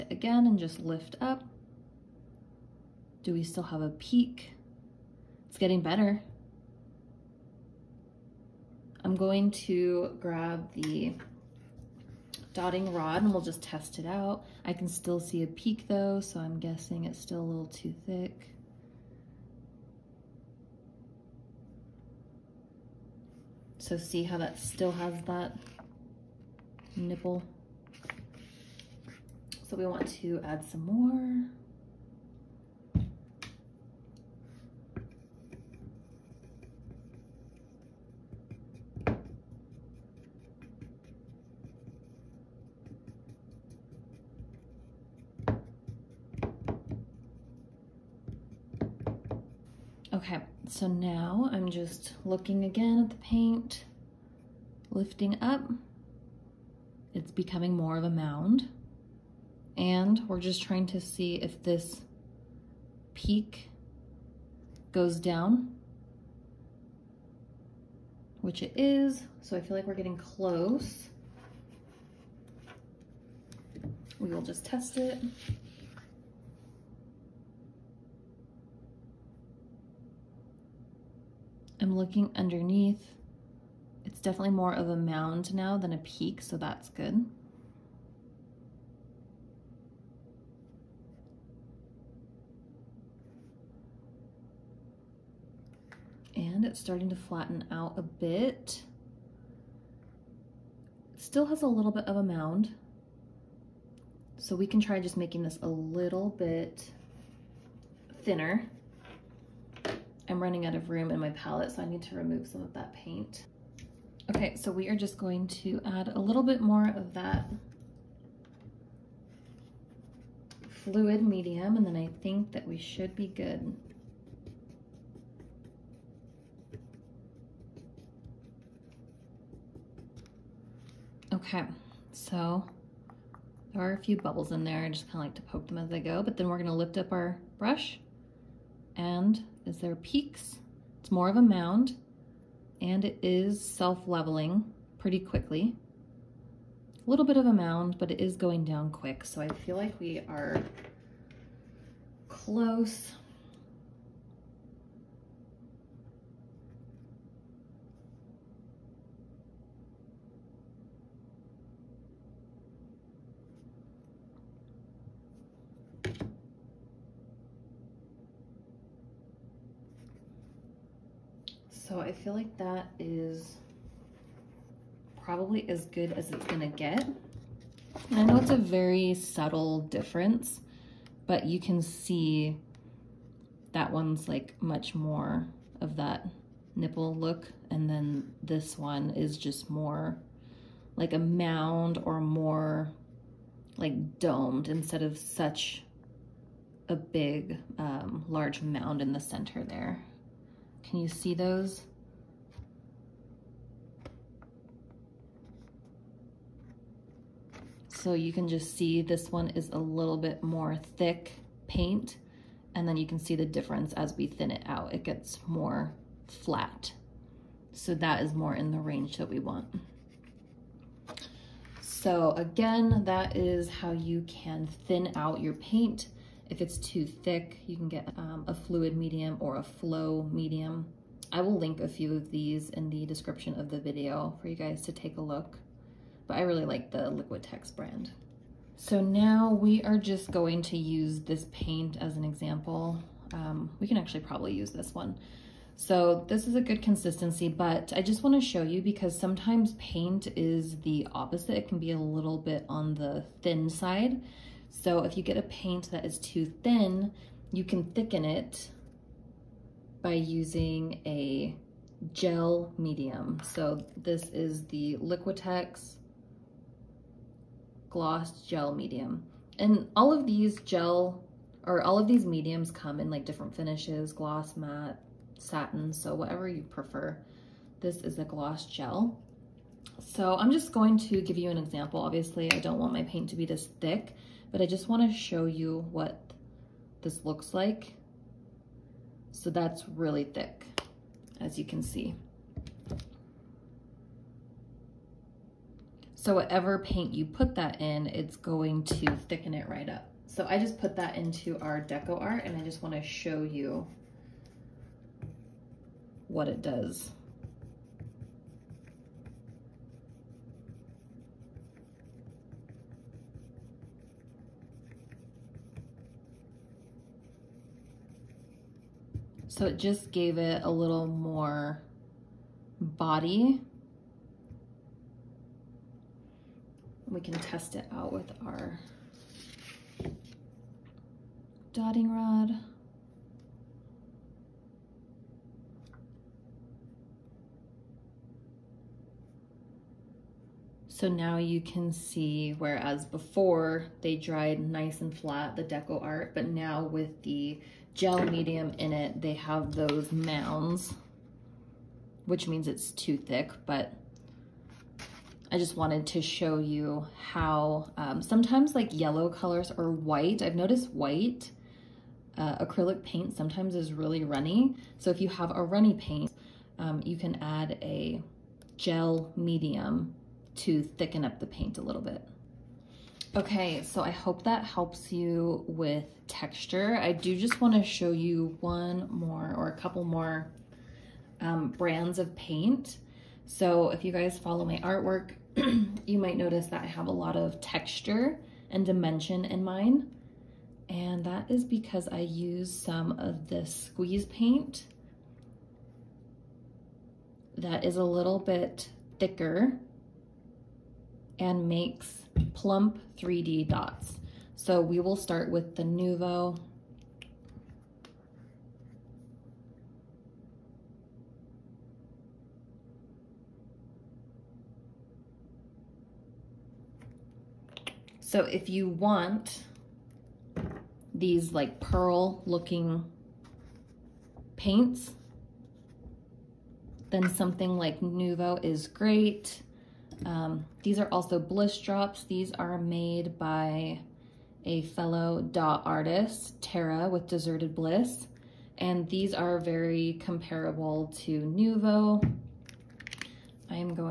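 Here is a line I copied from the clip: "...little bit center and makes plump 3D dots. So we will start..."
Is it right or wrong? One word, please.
wrong.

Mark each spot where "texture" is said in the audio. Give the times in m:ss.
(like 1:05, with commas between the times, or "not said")
6:16, 6:27.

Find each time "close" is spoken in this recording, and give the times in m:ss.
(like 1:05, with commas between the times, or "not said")
1:10, 2:32.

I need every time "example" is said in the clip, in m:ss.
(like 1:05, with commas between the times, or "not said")
4:02, 4:41.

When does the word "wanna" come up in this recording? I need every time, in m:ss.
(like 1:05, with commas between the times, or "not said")
4:08, 4:44, 5:02.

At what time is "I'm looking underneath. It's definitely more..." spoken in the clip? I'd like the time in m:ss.
1:21.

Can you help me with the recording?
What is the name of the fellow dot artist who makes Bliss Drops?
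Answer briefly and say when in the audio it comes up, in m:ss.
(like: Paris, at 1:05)
Tara, at 7:16.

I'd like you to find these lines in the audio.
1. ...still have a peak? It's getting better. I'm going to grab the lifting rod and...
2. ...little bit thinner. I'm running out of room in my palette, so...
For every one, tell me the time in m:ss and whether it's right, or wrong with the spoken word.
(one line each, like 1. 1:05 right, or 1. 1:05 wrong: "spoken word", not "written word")
1. 0:03 wrong: "dotting", not "lifting"
2. 1:45 right.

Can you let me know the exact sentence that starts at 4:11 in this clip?
It can be a little bit on the thin side.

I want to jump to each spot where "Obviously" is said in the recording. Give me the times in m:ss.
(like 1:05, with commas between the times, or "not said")
4:42.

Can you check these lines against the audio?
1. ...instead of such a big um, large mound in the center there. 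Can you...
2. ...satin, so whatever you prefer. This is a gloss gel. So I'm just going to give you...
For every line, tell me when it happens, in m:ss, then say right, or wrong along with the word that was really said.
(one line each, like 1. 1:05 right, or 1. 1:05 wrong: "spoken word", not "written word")
1. 3:14 right
2. 4:35 right.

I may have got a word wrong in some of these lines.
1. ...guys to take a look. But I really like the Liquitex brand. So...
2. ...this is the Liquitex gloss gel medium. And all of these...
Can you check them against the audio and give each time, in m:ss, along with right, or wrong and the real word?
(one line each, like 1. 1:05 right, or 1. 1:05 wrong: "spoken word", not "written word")
1. 3:54 right
2. 4:23 right.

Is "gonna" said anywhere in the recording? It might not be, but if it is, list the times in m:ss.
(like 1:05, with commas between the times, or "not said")
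2:16, 2:56.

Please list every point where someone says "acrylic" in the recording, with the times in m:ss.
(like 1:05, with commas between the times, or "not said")
6:02.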